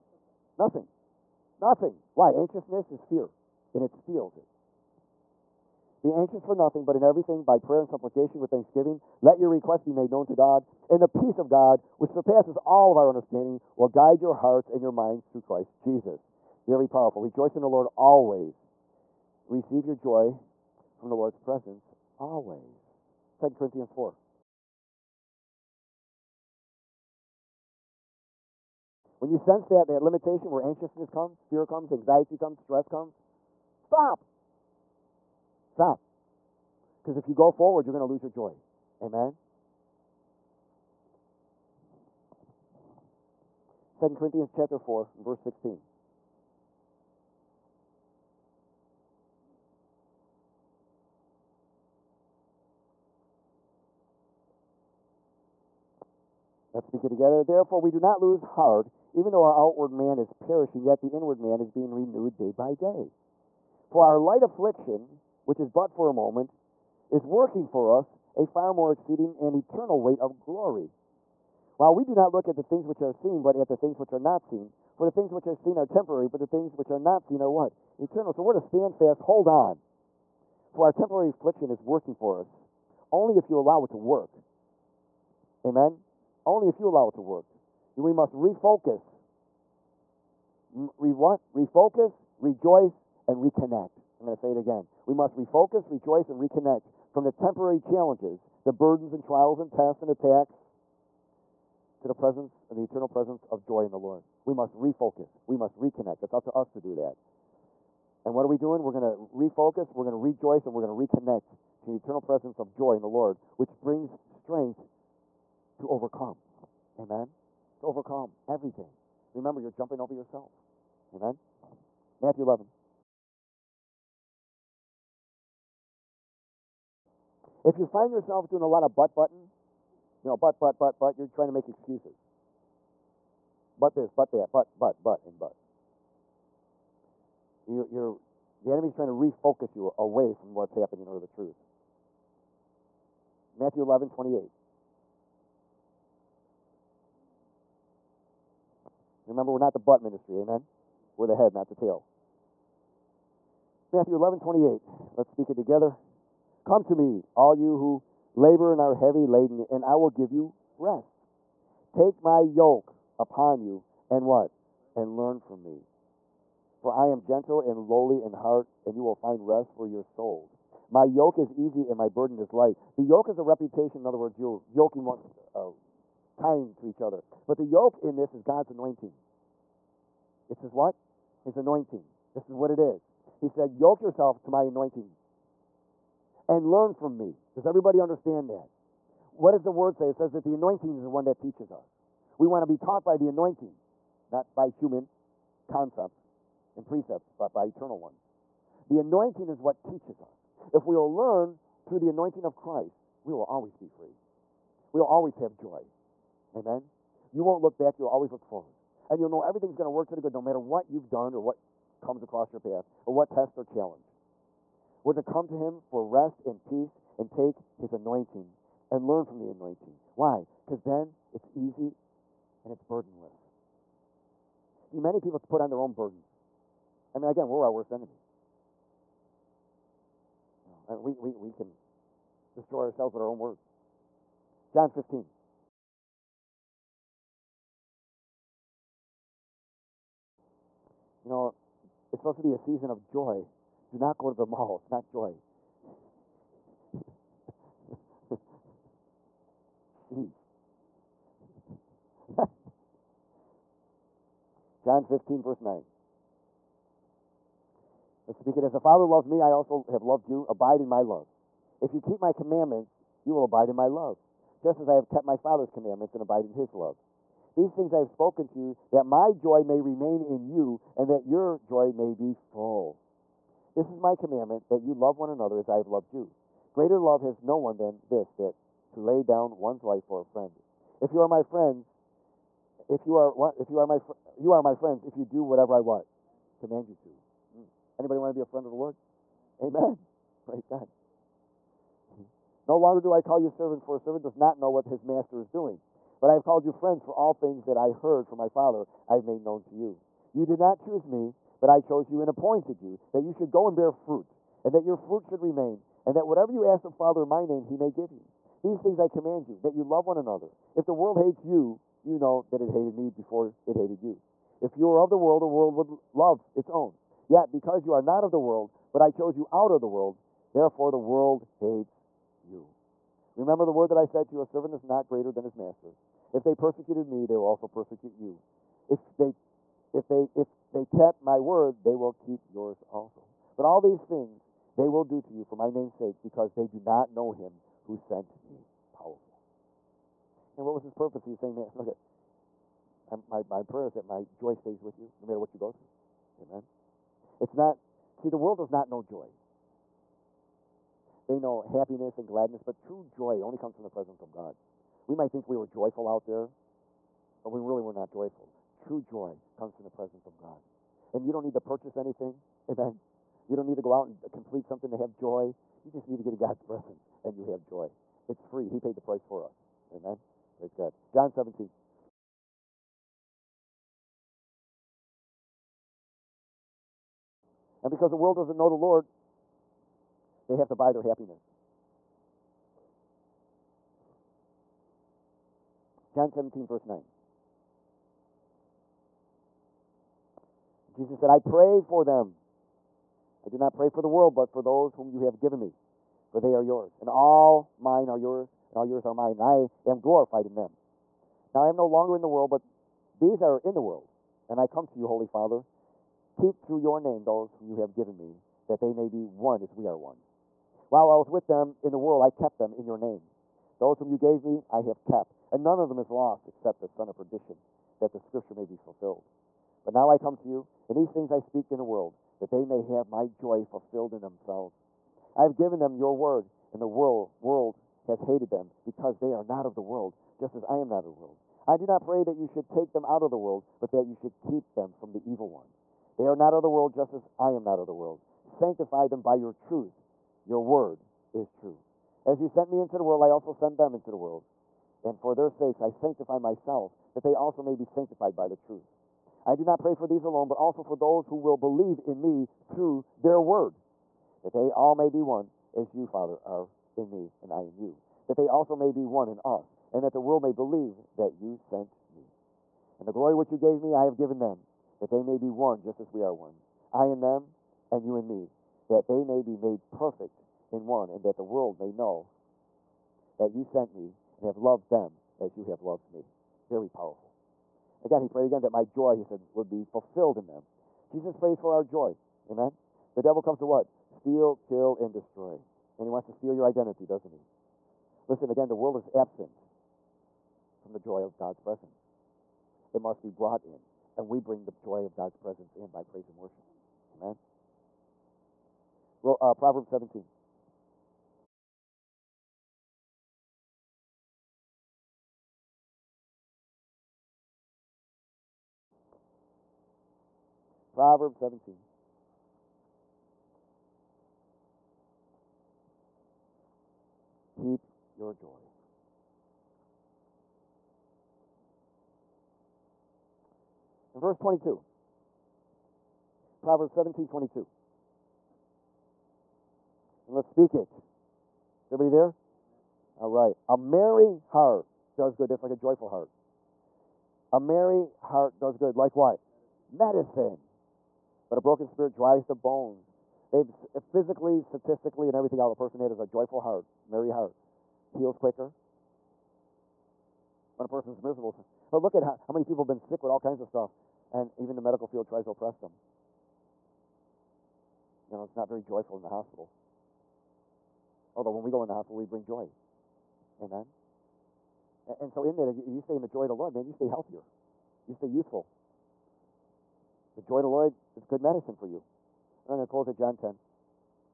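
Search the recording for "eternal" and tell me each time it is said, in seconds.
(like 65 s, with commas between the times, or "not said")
69 s, 78 s, 102 s, 111 s, 197 s.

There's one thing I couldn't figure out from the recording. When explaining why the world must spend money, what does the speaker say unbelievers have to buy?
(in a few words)
their happiness.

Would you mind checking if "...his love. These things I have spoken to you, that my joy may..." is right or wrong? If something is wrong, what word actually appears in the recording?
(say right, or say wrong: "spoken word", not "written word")
right.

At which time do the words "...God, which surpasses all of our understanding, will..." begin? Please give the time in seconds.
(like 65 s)
11 s.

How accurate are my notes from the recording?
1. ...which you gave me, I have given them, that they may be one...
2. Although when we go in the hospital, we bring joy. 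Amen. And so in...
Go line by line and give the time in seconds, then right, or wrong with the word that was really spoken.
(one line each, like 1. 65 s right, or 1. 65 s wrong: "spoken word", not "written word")
1. 463 s right
2. 561 s right.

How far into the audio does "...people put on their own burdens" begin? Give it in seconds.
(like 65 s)
225 s.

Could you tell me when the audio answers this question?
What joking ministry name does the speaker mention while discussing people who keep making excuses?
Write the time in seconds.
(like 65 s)
149 s.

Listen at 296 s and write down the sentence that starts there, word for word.
But I have called you friends, for all things that I heard from my Father I have made known to you.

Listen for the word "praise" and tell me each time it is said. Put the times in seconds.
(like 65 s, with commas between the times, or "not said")
290 s, 370 s, 496 s.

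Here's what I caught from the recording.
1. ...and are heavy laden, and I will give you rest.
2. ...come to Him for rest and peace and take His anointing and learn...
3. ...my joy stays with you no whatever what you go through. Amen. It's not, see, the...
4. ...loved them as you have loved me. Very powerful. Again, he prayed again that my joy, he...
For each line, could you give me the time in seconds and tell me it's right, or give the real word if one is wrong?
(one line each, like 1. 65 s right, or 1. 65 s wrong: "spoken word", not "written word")
1. 158 s right
2. 215 s right
3. 344 s wrong: "matter", not "whatever"
4. 474 s right.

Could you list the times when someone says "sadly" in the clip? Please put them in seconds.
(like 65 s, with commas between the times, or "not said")
not said.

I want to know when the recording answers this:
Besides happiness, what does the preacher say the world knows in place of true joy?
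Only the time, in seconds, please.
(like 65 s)
352 s.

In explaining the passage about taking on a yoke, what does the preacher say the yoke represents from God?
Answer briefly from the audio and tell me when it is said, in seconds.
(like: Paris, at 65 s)
God's anointing, at 178 s.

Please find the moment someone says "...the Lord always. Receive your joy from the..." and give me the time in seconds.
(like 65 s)
17 s.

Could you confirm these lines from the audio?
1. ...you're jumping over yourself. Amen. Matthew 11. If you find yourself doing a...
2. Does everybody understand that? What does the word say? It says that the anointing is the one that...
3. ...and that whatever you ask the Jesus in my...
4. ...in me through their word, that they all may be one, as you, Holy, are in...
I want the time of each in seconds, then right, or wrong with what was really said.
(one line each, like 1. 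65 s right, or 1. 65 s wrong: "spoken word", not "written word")
1. 119 s right
2. 187 s right
3. 306 s wrong: "Father", not "Jesus"
4. 452 s wrong: "Father", not "Holy".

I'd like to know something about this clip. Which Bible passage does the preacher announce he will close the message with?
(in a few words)
John 10.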